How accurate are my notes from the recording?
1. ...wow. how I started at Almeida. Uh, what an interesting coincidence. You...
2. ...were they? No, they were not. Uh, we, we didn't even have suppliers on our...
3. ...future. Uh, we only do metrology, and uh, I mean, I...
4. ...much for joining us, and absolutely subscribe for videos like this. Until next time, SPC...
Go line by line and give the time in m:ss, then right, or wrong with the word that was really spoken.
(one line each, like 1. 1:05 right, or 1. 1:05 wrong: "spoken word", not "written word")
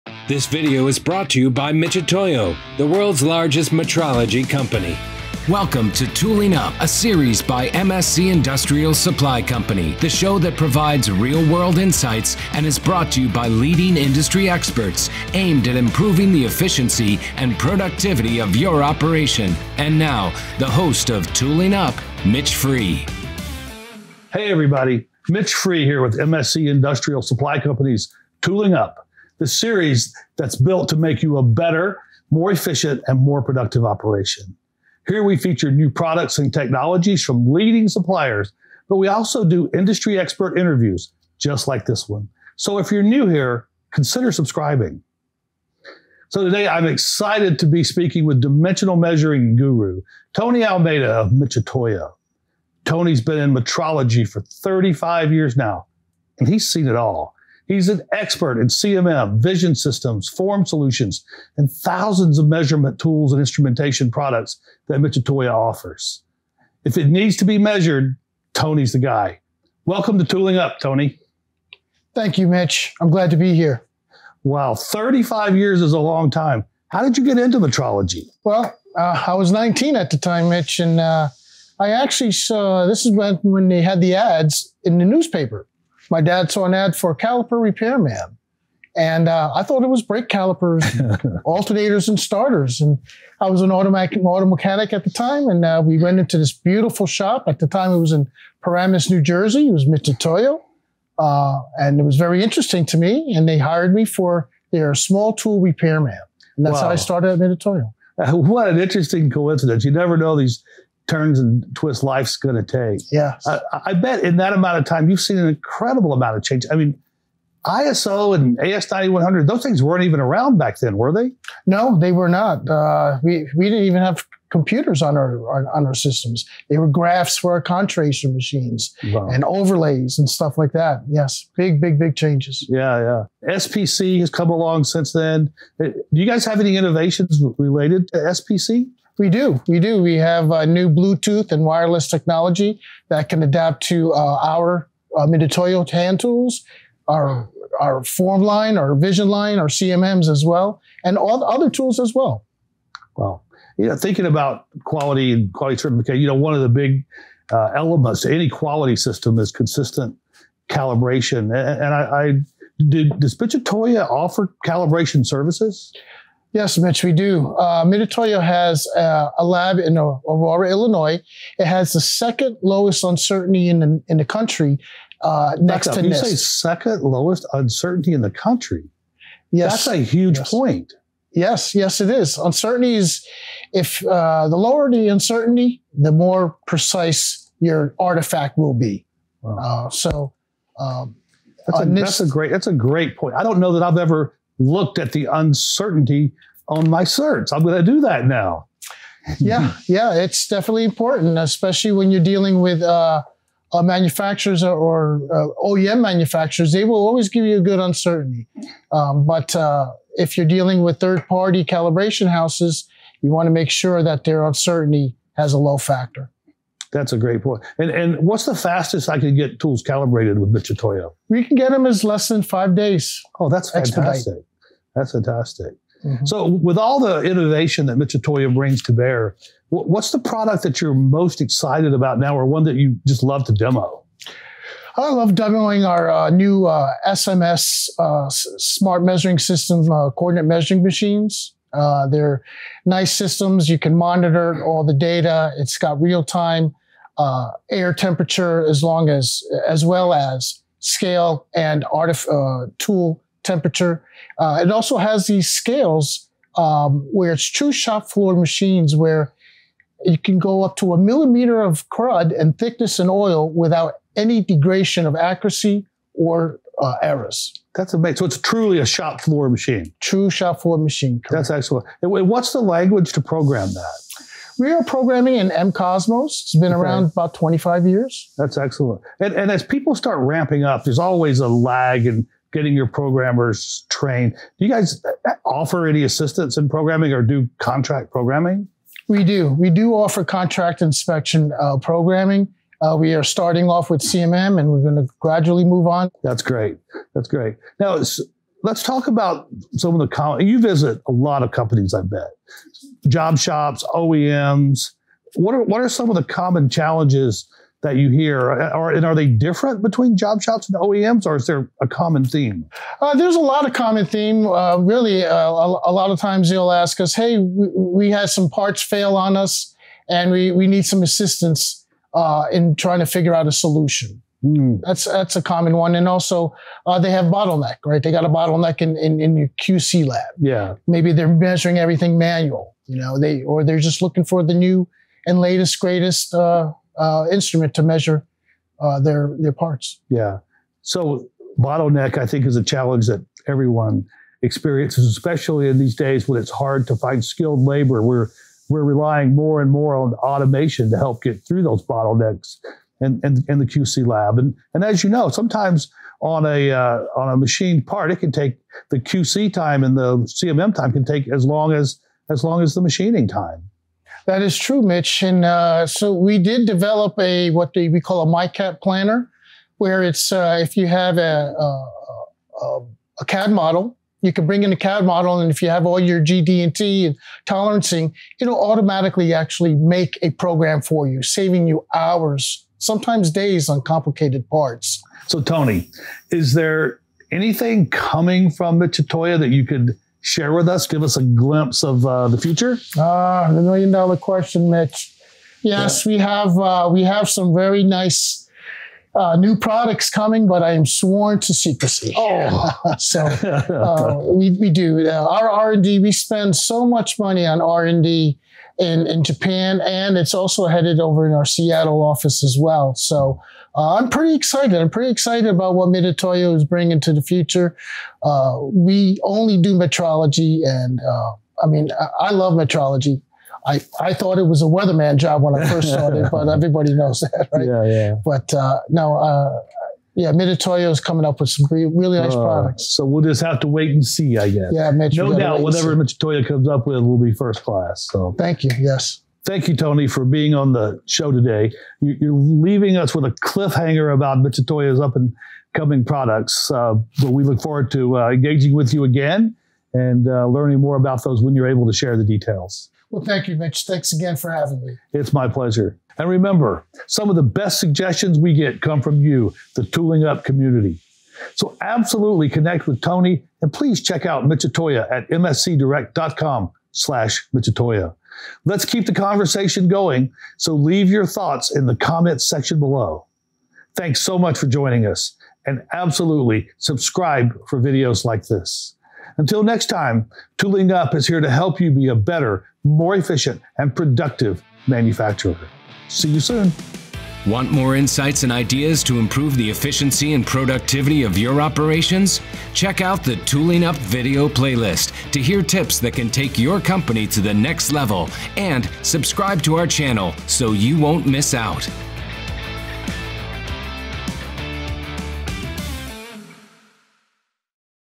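1. 1:46 wrong: "Mitutoyo", not "Almeida"
2. 2:00 wrong: "computers", not "suppliers"
3. 6:57 right
4. 7:54 wrong: "Tooling", not "SPC".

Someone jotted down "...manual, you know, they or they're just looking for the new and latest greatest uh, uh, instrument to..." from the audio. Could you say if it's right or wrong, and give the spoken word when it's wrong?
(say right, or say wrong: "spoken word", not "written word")
right.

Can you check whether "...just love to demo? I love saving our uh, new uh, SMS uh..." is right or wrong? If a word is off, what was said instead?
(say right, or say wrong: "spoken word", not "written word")
wrong: "demoing", not "saving".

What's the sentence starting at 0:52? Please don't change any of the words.
Tony's been in metrology for 35 years now, and he's seen it all.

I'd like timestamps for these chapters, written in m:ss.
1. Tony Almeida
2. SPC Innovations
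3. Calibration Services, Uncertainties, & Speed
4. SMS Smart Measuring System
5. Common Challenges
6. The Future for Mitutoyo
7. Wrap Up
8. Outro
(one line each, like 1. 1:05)
1. 0:46
2. 2:12
3. 2:42
4. 3:46
5. 5:05
6. 6:24
7. 7:19
8. 8:07.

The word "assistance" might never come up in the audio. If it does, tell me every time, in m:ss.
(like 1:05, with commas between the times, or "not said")
4:46, 5:21.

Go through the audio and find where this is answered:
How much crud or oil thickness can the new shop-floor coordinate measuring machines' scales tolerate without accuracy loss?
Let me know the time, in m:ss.
4:20.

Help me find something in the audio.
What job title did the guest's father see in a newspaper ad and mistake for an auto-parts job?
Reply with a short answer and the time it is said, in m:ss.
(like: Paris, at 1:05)
Caliper repairman, at 1:27.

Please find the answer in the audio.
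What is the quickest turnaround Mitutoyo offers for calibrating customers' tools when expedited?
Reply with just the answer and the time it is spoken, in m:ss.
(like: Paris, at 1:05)
Less than 5 days, at 3:42.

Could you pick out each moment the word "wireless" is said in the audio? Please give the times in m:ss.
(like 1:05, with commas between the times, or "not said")
2:21.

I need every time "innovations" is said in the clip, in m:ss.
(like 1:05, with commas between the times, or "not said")
2:16, 3:47.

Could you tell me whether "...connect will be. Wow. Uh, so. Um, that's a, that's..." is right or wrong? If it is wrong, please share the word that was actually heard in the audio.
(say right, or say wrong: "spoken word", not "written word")
wrong: "artifact", not "connect".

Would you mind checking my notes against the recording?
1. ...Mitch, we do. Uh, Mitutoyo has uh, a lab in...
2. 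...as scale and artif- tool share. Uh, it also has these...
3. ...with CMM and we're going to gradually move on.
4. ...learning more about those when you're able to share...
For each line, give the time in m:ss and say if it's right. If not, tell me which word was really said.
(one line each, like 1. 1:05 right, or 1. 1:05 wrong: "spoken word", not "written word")
1. 2:46 right
2. 4:10 wrong: "temperature", not "share"
3. 4:53 right
4. 7:30 right.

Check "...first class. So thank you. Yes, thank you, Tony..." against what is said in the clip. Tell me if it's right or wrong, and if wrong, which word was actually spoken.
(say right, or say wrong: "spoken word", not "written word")
right.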